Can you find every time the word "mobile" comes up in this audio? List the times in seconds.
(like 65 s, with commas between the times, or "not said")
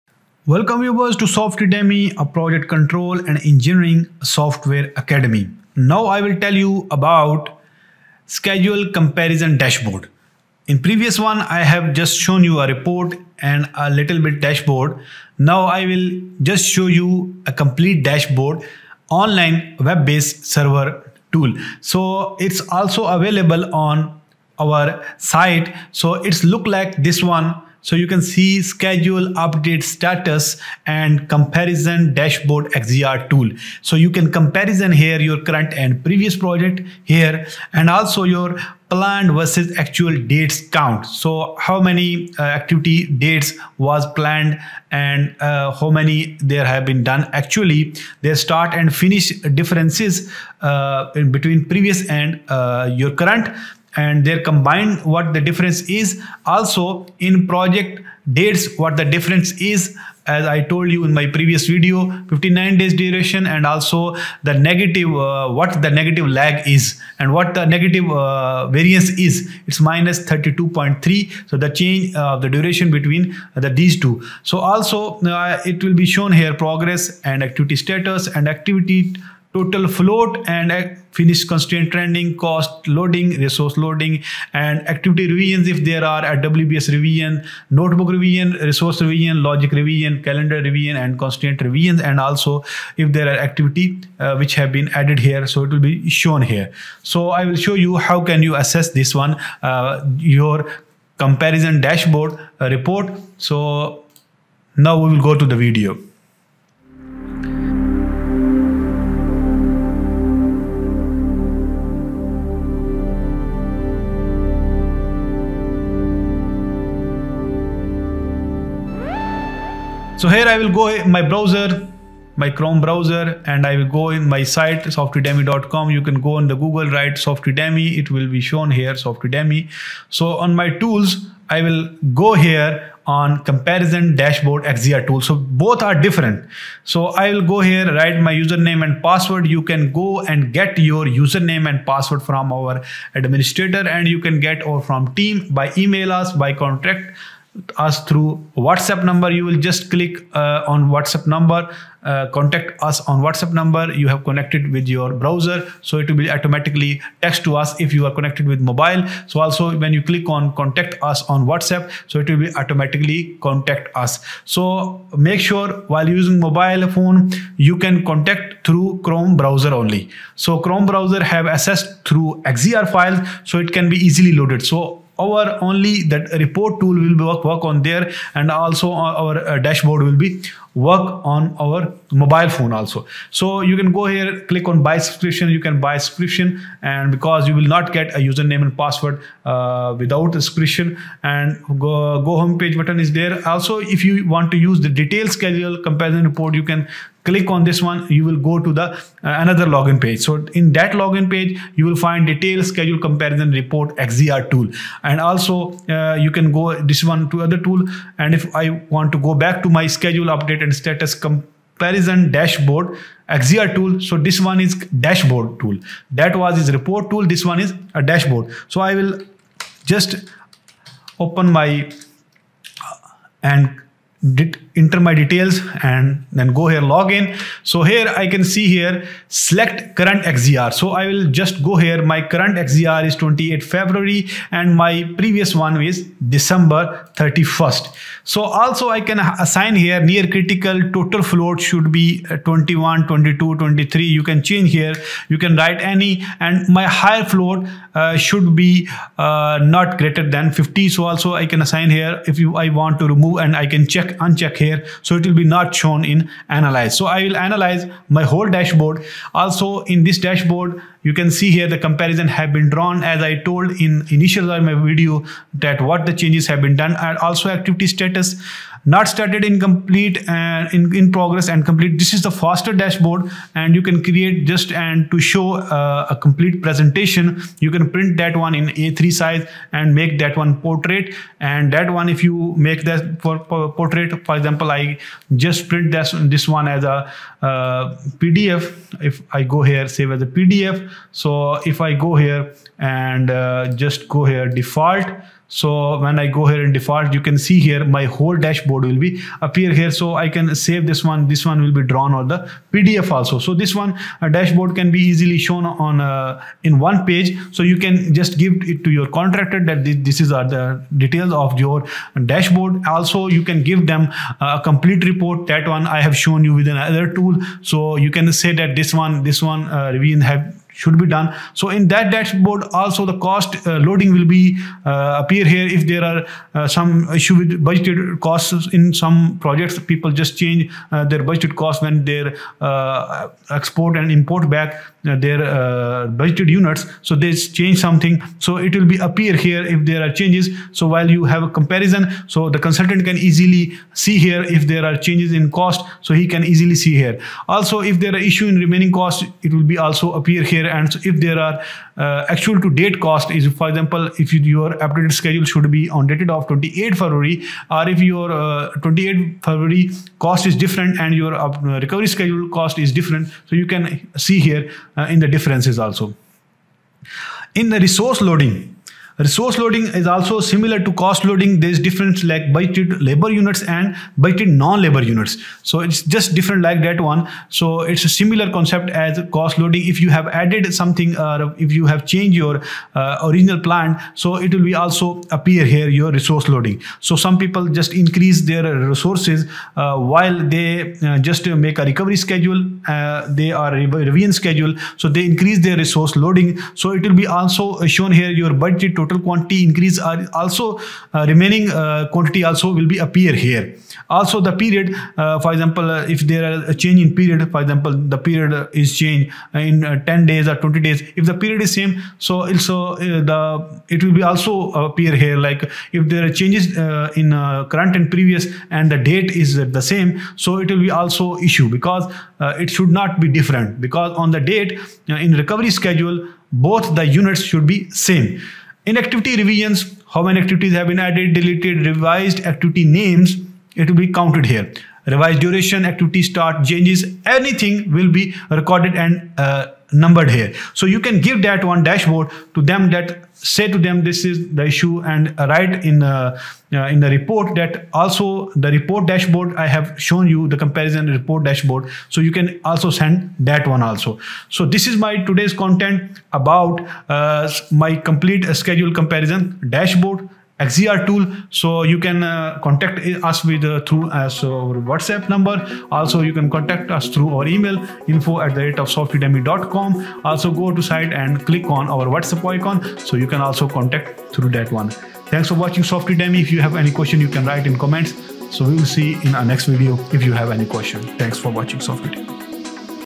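158 s, 166 s, 182 s.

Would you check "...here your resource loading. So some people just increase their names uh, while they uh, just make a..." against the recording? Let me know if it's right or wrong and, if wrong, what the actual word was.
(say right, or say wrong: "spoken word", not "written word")
wrong: "resources", not "names".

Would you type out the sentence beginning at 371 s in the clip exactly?
There's difference like budgeted labor units and budgeted non-labor units.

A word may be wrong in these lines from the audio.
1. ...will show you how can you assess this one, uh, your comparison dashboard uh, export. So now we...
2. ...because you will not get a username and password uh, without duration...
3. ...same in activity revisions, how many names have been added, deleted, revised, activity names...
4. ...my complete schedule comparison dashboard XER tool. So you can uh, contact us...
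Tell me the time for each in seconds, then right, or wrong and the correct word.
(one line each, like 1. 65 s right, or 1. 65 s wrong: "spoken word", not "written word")
1. 97 s wrong: "report", not "export"
2. 187 s wrong: "subscription", not "duration"
3. 427 s wrong: "activities", not "names"
4. 457 s right.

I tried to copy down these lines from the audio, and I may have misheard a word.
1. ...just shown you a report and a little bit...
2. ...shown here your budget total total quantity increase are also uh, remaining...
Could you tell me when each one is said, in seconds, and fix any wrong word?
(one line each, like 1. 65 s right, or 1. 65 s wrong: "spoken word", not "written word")
1. 11 s right
2. 397 s right.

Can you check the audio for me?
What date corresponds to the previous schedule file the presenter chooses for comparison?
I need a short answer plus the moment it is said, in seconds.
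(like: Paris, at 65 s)
December 31st, at 236 s.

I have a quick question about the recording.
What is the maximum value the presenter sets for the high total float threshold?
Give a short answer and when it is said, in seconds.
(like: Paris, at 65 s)
50, at 250 s.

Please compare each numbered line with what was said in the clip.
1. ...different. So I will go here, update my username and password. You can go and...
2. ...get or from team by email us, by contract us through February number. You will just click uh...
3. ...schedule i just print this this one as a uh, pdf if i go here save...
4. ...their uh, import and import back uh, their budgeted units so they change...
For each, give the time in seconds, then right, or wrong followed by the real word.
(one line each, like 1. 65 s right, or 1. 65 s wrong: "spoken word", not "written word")
1. 135 s wrong: "write", not "update"
2. 144 s wrong: "WhatsApp", not "February"
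3. 284 s wrong: "example", not "schedule"
4. 332 s wrong: "export", not "import".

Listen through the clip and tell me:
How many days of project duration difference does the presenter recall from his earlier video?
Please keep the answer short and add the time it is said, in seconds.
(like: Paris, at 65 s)
59 days, at 62 s.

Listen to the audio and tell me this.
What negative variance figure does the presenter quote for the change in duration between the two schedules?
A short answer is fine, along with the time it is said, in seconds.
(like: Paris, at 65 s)
-32.3, at 69 s.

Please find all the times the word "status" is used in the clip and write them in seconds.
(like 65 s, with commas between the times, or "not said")
29 s, 77 s, 210 s, 267 s.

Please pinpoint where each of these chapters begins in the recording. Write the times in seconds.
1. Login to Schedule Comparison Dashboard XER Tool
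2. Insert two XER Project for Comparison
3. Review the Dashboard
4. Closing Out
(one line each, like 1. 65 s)
1. 120 s
2. 226 s
3. 257 s
4. 448 s.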